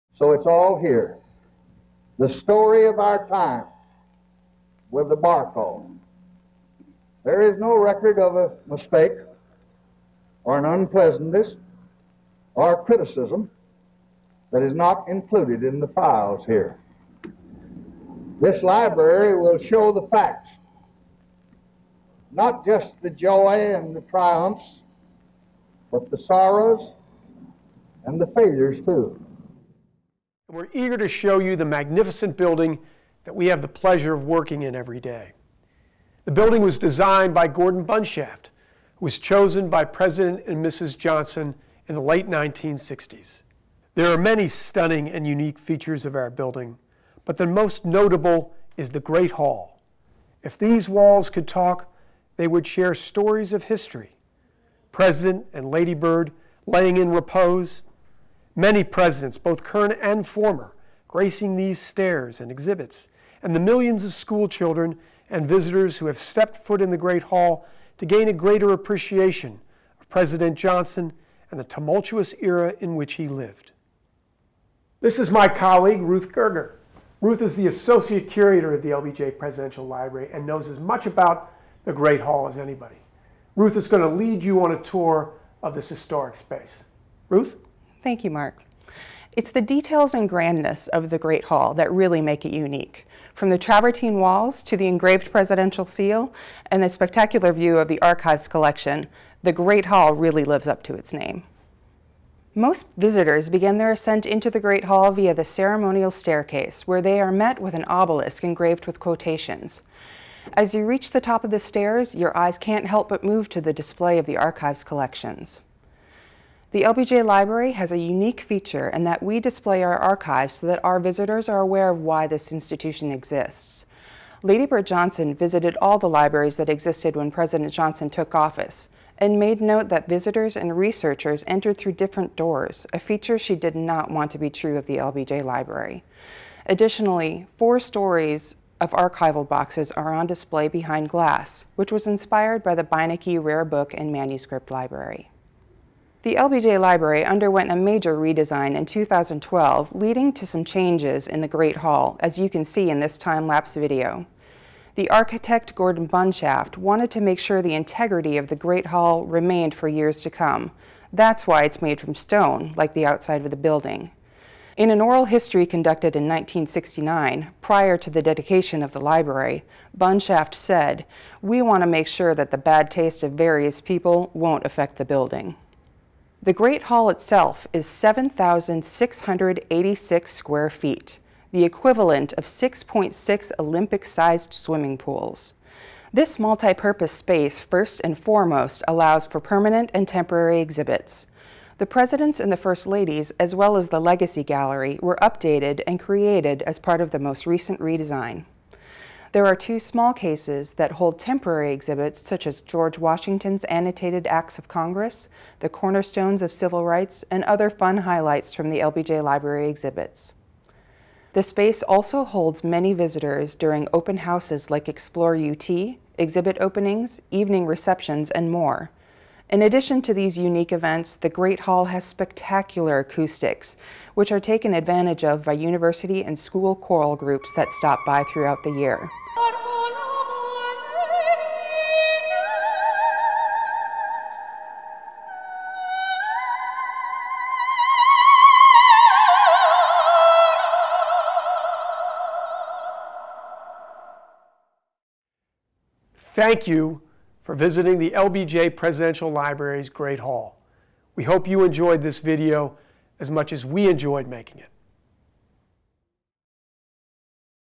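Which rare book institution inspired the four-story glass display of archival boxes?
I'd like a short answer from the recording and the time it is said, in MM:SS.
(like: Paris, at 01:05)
Beinecke Rare Book and Manuscript Library, at 02:22.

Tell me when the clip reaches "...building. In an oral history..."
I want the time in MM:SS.
02:43.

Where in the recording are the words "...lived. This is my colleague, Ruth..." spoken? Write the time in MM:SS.
01:13.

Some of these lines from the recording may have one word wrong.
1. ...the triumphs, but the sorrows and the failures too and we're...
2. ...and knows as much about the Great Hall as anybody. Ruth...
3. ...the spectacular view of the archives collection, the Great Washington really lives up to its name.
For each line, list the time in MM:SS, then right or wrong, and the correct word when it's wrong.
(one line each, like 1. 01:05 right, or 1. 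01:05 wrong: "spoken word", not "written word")
1. 00:23 right
2. 01:20 right
3. 01:36 wrong: "Hall", not "Washington".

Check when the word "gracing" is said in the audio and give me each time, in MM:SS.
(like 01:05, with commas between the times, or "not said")
01:01.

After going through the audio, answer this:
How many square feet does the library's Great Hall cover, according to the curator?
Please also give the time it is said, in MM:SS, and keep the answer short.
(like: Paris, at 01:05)
7,686, at 02:57.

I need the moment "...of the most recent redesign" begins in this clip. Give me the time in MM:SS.
03:17.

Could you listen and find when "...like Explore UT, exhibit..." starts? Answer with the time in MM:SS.
03:34.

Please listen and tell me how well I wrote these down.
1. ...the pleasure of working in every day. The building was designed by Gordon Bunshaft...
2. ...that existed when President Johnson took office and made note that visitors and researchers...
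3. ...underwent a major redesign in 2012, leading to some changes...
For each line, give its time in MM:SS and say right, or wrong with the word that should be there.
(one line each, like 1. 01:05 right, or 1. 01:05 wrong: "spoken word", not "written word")
1. 00:33 right
2. 02:06 right
3. 02:27 right.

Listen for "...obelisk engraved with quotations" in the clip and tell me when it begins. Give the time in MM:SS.
01:47.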